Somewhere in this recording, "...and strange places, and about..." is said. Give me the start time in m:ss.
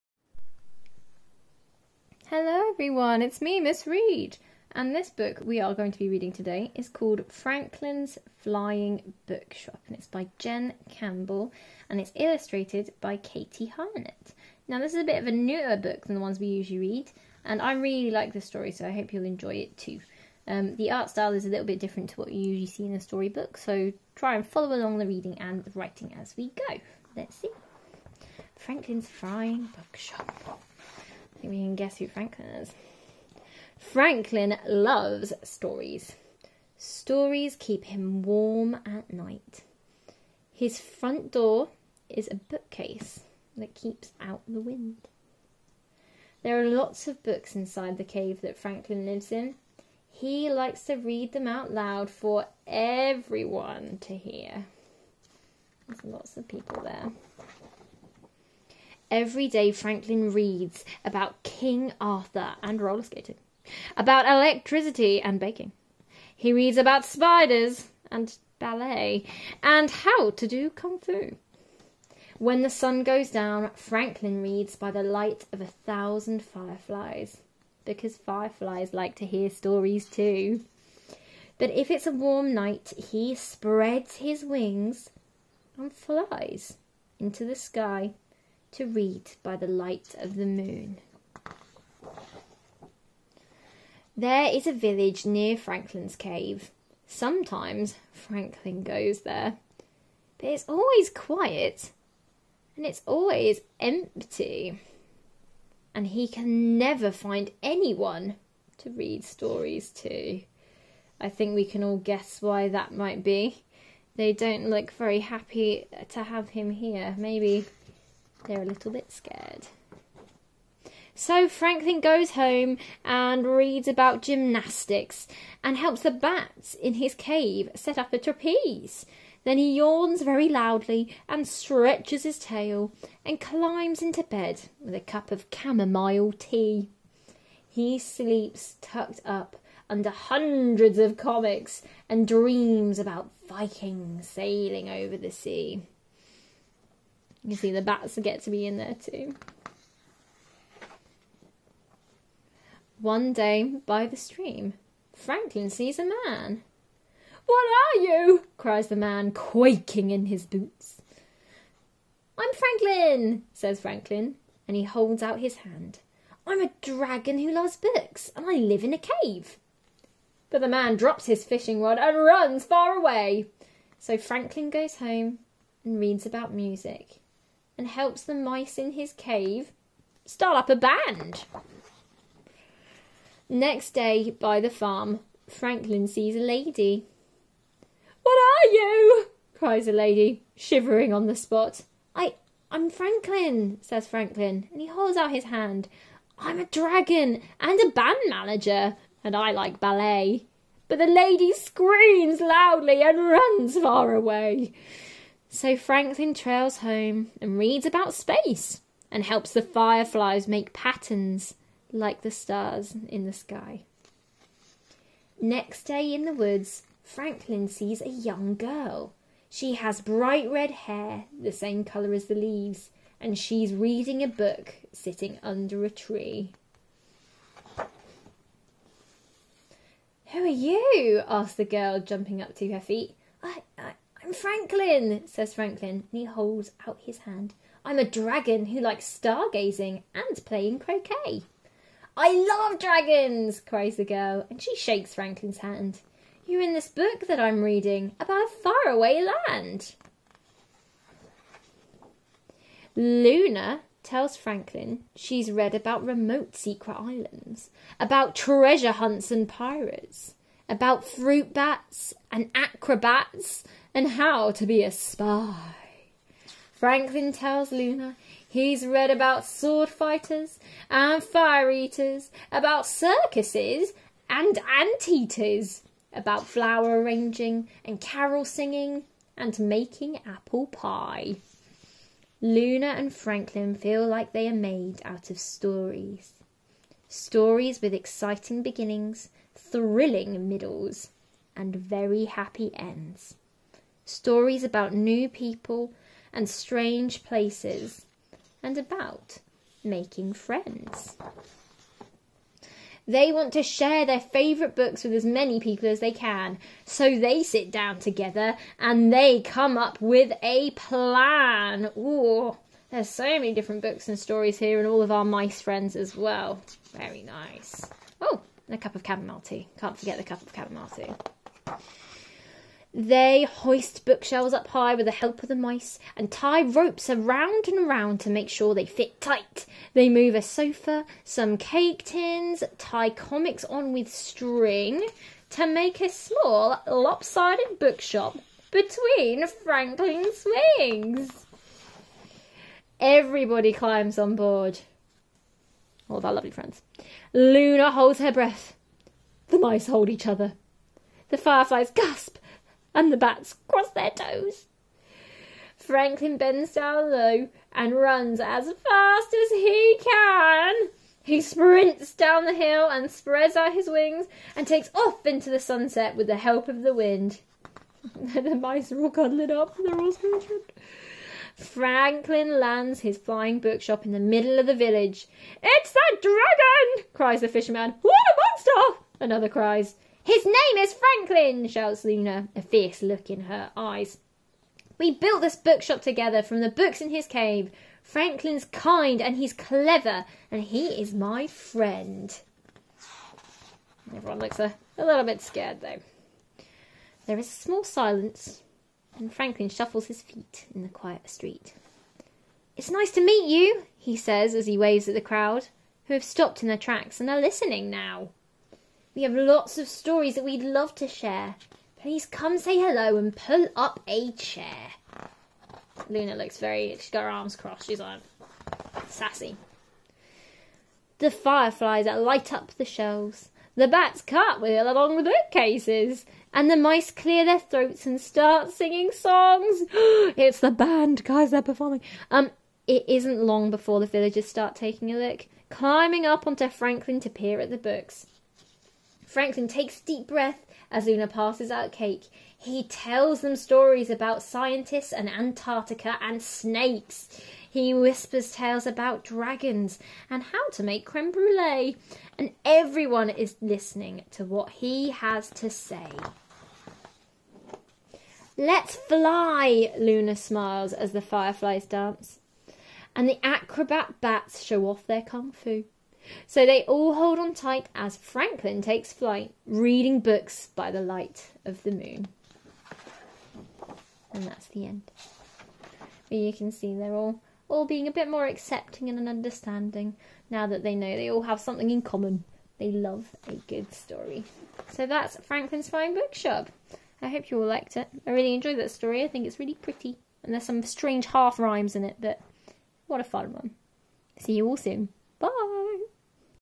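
4:56.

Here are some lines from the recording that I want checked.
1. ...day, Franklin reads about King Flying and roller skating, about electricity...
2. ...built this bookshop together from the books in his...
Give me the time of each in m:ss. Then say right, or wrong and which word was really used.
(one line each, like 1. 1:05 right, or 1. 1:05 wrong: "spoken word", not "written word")
1. 0:59 wrong: "Arthur", not "Flying"
2. 6:25 right.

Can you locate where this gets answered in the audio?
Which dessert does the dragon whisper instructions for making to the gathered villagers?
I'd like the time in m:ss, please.
7:31.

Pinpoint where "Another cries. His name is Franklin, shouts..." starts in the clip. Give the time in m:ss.
6:19.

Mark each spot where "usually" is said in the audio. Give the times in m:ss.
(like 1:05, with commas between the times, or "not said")
0:16, 0:22.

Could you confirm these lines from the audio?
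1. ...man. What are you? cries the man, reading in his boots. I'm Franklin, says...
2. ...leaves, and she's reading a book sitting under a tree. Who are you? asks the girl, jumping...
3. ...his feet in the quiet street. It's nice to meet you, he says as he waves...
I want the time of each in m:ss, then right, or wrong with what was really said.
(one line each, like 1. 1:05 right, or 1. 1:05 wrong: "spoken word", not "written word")
1. 2:36 wrong: "quaking", not "reading"
2. 3:42 right
3. 6:40 right.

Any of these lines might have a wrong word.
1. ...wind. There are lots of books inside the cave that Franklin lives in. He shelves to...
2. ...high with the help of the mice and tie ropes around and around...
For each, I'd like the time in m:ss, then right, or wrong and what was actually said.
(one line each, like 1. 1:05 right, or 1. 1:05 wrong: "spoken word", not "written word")
1. 0:44 wrong: "likes", not "shelves"
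2. 5:24 right.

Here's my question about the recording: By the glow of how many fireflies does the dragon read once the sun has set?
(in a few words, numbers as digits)
1000.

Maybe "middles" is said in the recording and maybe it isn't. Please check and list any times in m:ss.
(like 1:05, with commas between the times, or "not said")
4:50, 6:14.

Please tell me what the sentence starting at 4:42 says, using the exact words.
Luna and Franklin feel like they are made out of stories.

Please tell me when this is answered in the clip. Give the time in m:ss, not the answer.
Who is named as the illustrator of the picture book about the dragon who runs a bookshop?
0:13.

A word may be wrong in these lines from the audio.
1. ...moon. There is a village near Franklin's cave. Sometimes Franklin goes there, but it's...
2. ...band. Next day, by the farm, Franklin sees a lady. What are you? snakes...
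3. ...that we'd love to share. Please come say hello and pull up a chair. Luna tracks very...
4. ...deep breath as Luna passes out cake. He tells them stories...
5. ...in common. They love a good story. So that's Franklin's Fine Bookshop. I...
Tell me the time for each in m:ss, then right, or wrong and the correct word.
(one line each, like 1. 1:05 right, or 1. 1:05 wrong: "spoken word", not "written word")
1. 1:30 right
2. 3:00 wrong: "cries", not "snakes"
3. 6:50 wrong: "looks", not "tracks"
4. 7:20 right
5. 8:01 right.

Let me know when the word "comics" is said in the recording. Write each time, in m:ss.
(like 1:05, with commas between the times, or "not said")
2:21, 5:33.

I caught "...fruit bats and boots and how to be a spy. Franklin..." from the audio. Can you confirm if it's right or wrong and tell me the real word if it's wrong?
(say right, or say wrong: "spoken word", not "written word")
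wrong: "acrobats", not "boots".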